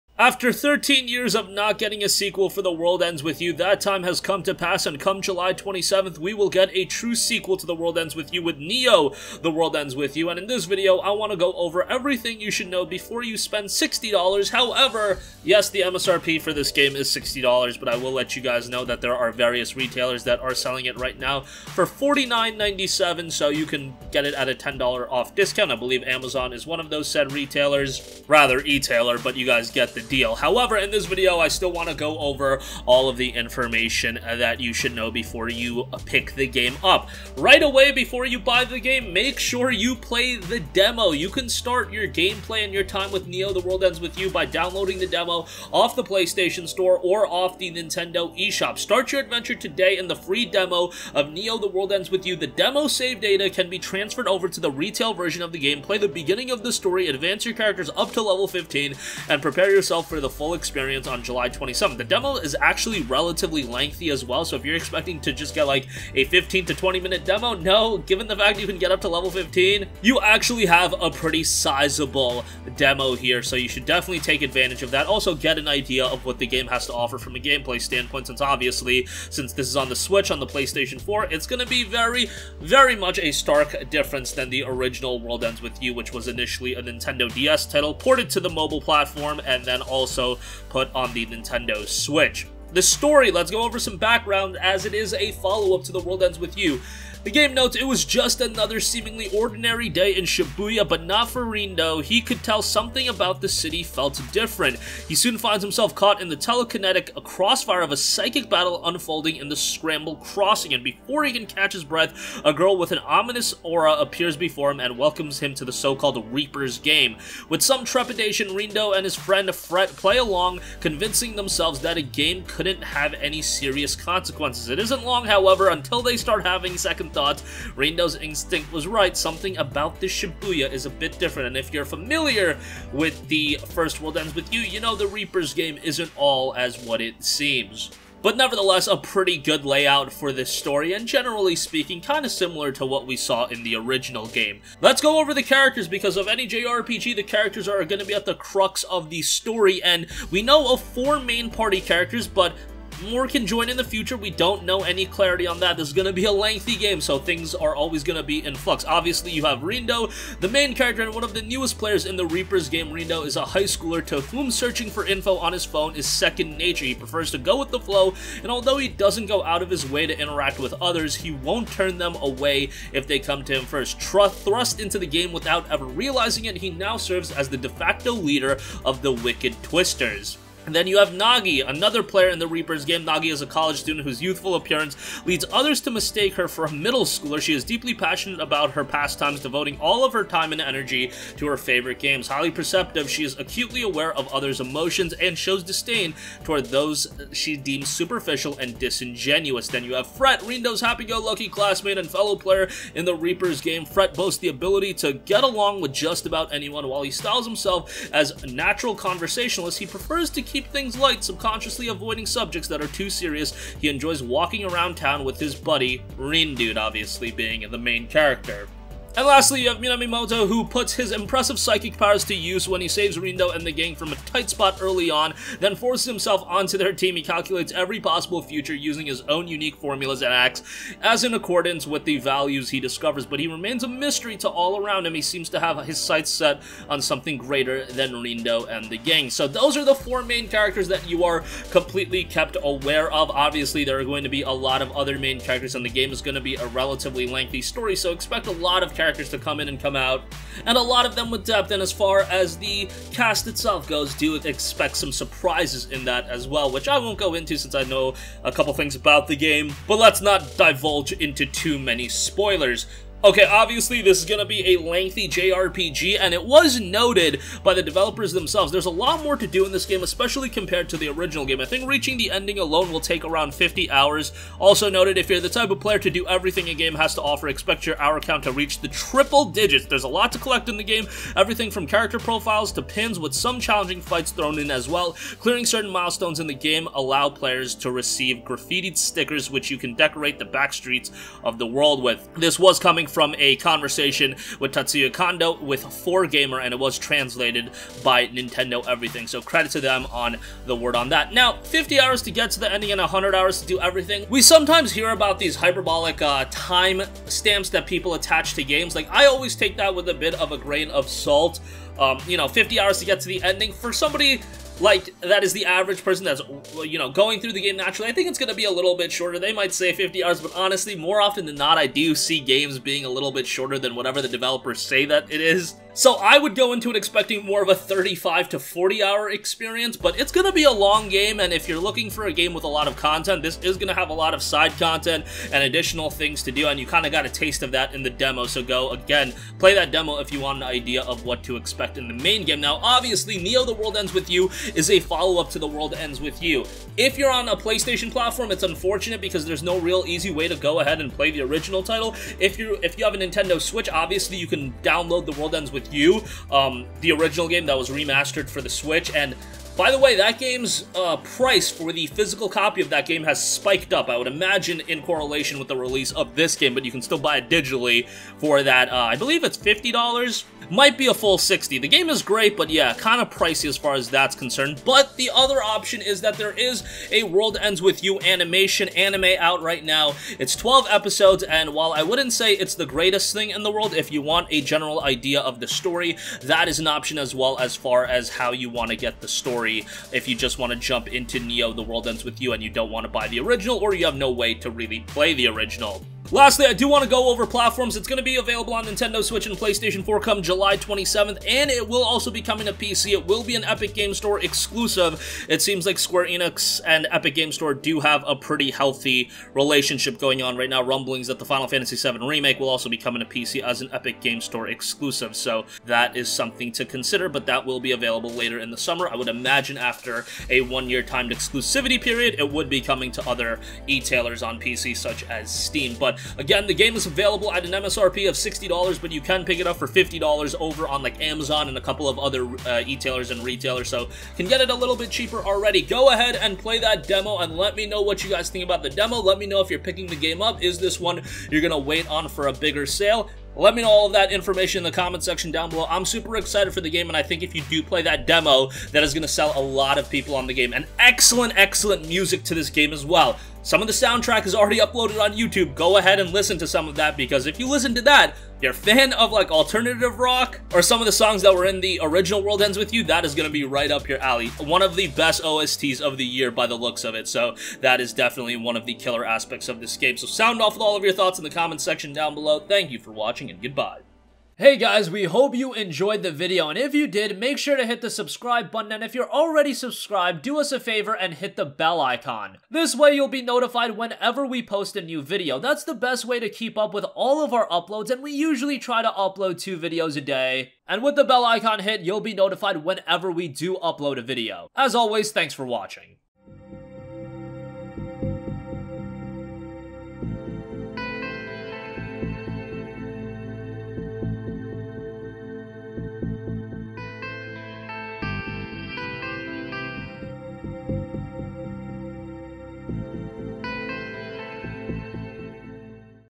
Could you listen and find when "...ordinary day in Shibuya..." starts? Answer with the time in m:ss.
1:39.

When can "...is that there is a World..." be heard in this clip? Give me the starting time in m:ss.
6:16.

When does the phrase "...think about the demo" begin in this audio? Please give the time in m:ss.
7:18.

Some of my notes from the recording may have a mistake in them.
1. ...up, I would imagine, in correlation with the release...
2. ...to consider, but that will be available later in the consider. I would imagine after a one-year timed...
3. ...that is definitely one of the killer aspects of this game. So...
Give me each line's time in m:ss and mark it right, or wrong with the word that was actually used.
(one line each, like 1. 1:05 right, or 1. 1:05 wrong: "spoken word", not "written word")
1. 6:03 right
2. 6:56 wrong: "summer", not "consider"
3. 7:47 right.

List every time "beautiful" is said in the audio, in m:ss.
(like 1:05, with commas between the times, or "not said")
not said.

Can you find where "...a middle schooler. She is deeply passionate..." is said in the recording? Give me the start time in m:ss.
3:06.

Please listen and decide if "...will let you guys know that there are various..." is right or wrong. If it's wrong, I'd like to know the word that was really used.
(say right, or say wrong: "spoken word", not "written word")
right.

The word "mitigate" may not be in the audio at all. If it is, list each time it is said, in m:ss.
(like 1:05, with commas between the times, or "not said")
not said.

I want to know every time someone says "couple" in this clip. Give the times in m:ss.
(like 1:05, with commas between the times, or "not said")
4:18, 7:11.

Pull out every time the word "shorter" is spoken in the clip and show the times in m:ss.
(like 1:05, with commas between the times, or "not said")
5:19, 5:23.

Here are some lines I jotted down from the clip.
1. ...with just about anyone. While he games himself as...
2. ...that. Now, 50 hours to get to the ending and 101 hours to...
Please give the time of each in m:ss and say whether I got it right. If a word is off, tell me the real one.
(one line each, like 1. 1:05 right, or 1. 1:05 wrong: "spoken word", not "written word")
1. 3:25 wrong: "styles", not "games"
2. 5:01 wrong: "100", not "101".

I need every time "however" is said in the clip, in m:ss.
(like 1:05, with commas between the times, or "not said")
0:14, 0:30, 2:05.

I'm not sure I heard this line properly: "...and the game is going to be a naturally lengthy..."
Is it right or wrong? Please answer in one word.
wrong.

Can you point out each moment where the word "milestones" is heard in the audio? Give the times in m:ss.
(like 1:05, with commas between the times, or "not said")
4:45.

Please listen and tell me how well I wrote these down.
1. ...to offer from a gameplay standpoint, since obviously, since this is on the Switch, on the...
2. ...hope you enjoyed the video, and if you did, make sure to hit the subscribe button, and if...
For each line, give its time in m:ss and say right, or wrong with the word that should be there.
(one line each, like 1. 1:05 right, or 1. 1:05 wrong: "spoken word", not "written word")
1. 1:16 right
2. 7:55 right.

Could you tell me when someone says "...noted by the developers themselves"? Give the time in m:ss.
4:26.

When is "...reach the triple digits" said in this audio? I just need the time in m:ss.
4:38.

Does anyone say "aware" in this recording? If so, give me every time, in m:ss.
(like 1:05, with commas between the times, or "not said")
3:13, 4:02.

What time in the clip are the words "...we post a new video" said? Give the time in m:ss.
8:04.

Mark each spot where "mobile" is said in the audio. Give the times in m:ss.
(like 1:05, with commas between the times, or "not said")
1:28.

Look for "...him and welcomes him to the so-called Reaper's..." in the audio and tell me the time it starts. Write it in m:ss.
1:54.